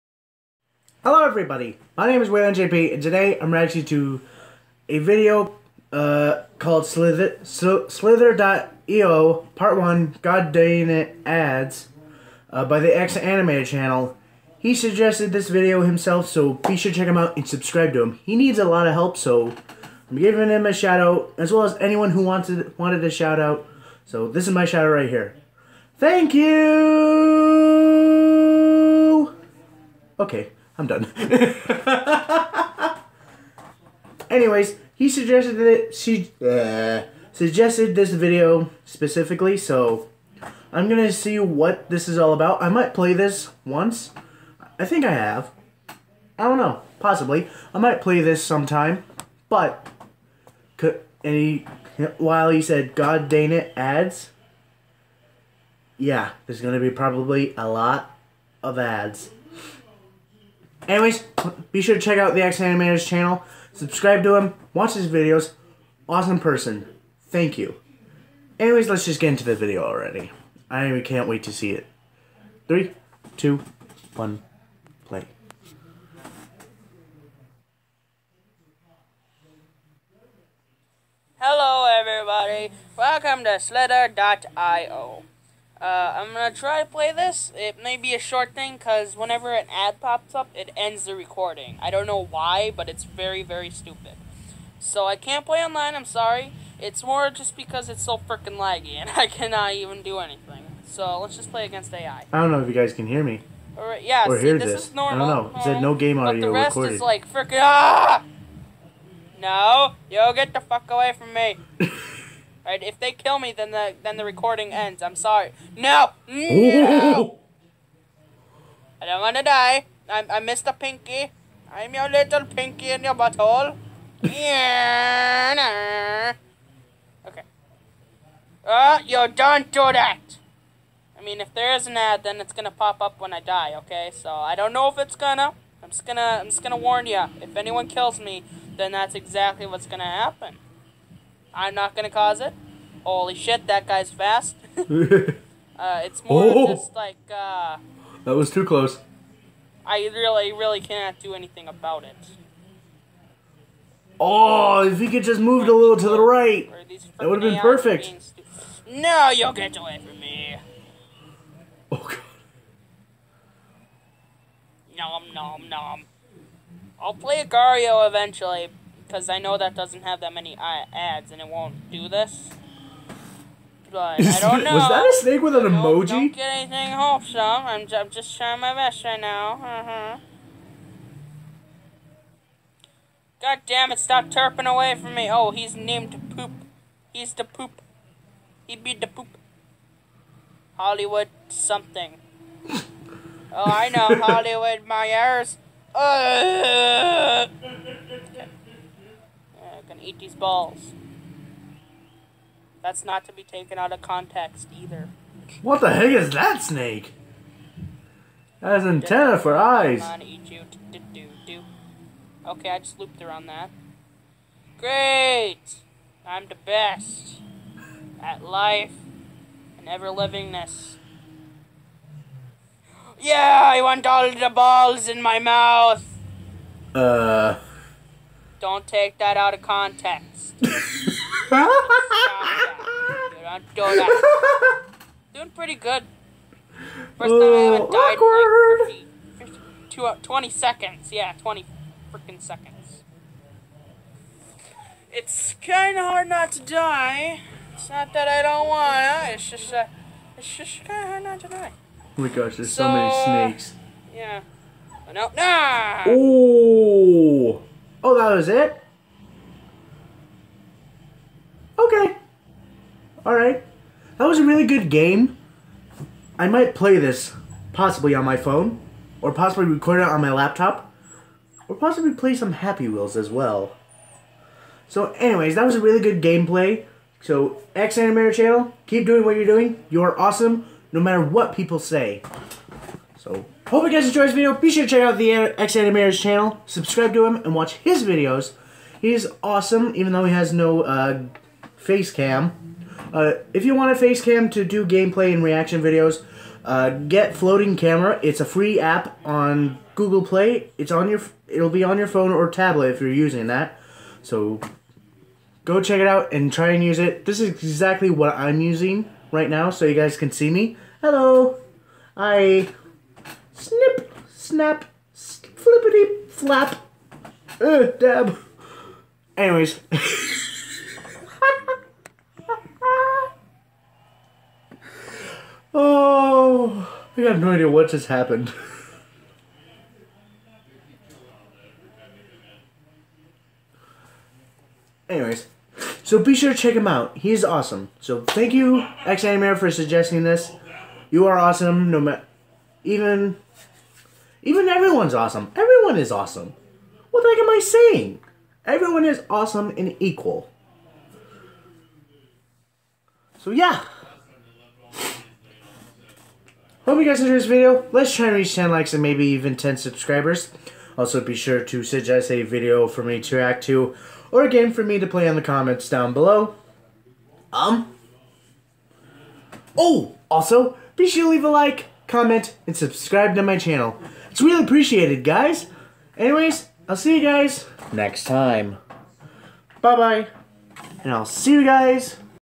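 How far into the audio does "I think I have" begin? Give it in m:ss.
0:44.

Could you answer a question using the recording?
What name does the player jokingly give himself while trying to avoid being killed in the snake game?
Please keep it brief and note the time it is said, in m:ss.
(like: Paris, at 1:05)
Mr. Pinky, at 2:00.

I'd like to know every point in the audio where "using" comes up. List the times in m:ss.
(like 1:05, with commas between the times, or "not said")
5:03, 5:08.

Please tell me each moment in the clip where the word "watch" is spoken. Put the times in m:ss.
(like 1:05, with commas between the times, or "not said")
1:04, 4:47.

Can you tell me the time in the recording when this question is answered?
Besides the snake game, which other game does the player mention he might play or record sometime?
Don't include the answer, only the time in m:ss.
4:32.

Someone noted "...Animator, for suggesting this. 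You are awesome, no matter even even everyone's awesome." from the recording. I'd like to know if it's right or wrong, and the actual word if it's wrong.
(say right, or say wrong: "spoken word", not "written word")
right.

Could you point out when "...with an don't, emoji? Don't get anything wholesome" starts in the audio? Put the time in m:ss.
2:55.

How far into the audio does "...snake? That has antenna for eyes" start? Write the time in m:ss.
3:26.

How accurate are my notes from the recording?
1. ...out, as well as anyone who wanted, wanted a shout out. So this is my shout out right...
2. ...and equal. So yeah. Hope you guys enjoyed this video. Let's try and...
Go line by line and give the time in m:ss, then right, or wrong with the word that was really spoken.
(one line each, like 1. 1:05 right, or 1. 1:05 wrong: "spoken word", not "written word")
1. 0:21 right
2. 5:49 right.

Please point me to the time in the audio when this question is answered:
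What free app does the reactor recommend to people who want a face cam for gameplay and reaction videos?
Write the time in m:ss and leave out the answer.
4:57.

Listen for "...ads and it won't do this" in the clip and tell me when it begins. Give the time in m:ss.
2:50.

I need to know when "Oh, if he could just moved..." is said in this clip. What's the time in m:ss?
2:34.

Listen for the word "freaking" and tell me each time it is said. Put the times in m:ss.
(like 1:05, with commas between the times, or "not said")
1:38, 1:47, 4:02.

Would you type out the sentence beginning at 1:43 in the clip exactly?
All right, yeah, or see, hear this, this.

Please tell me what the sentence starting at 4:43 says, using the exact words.
So, hope you guys enjoyed this video.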